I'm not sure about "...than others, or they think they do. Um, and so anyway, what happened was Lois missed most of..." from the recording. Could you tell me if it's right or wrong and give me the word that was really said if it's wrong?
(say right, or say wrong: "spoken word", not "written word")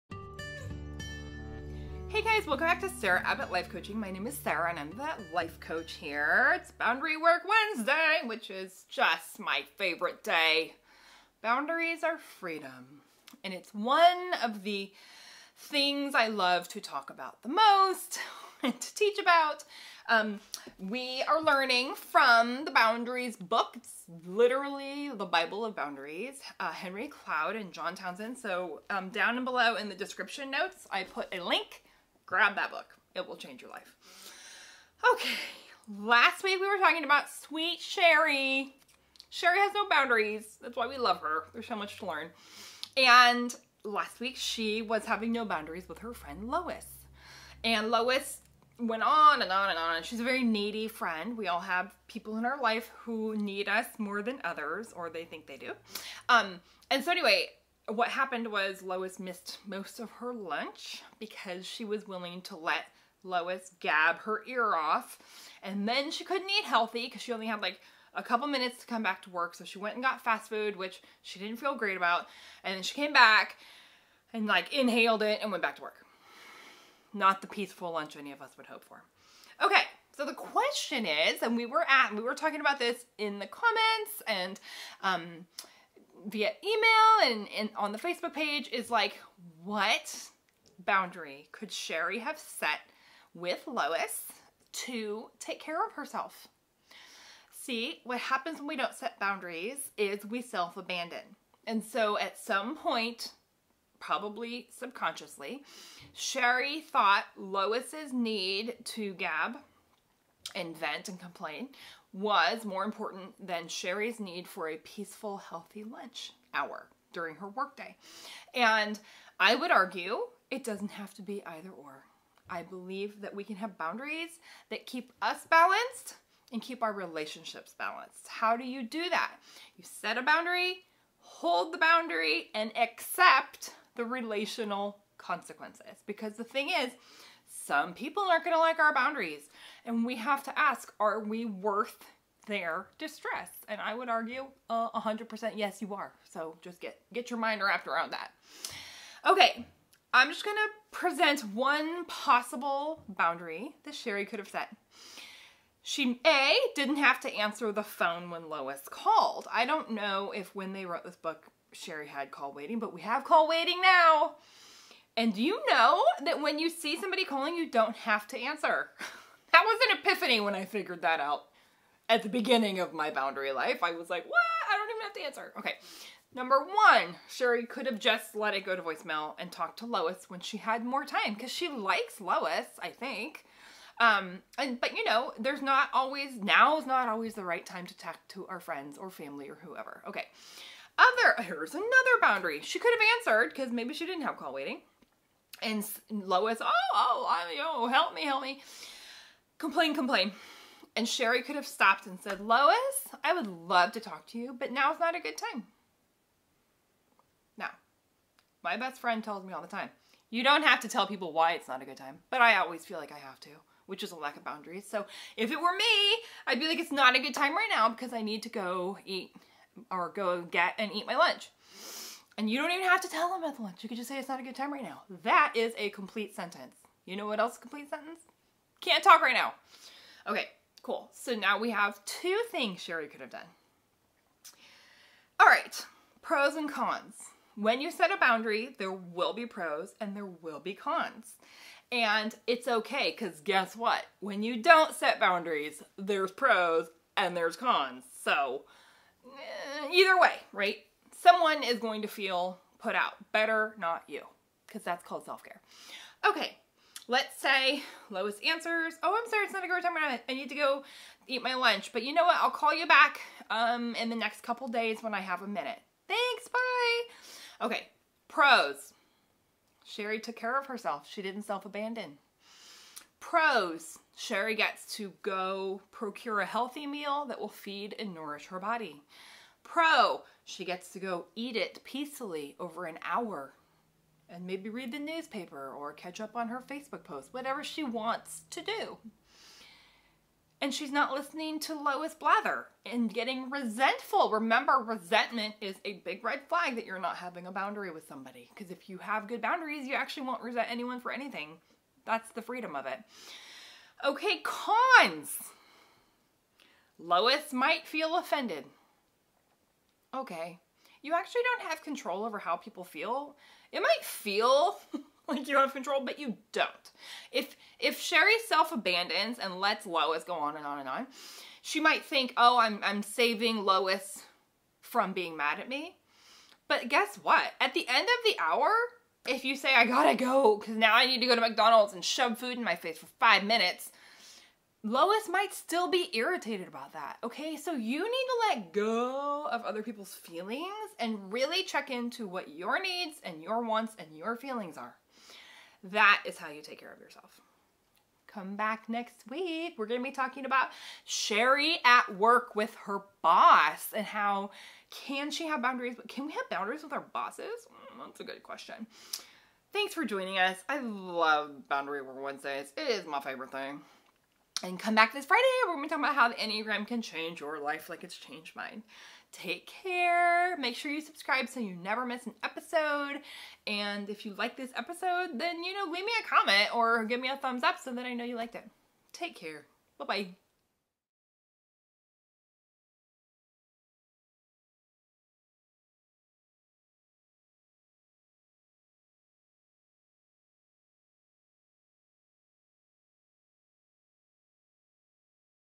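right.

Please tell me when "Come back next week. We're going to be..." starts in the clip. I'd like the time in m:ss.
5:48.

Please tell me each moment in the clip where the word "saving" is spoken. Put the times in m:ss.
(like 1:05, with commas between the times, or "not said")
5:23.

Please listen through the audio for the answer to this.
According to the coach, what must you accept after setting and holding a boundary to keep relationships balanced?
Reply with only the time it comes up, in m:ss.
2:13.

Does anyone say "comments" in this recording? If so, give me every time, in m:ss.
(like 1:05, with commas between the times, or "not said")
1:23, 6:16.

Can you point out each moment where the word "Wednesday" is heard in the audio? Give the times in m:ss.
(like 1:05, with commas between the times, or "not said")
0:07, 6:02.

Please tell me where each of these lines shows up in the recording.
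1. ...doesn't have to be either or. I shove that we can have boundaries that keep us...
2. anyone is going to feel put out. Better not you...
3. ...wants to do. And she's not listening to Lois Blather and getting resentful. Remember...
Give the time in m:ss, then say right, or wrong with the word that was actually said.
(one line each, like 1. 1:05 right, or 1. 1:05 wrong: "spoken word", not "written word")
1. 2:00 wrong: "believe", not "shove"
2. 4:11 wrong: "someone", not "anyone"
3. 4:47 right.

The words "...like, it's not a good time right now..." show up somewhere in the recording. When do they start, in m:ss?
3:36.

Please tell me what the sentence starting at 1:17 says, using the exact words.
Not the peaceful lunch any of us would hope for.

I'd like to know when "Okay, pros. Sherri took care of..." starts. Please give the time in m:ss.
4:27.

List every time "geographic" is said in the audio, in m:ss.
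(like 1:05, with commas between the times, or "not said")
not said.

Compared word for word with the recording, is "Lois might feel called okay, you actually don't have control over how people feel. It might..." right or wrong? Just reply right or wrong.
wrong.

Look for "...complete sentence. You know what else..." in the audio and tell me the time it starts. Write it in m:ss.
3:45.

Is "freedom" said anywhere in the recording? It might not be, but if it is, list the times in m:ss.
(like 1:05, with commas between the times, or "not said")
0:12, 5:02.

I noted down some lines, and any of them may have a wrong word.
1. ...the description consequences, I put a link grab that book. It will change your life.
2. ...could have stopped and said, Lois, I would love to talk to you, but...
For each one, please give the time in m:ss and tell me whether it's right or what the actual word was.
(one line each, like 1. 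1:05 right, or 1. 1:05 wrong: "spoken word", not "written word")
1. 0:29 wrong: "notes", not "consequences"
2. 3:21 right.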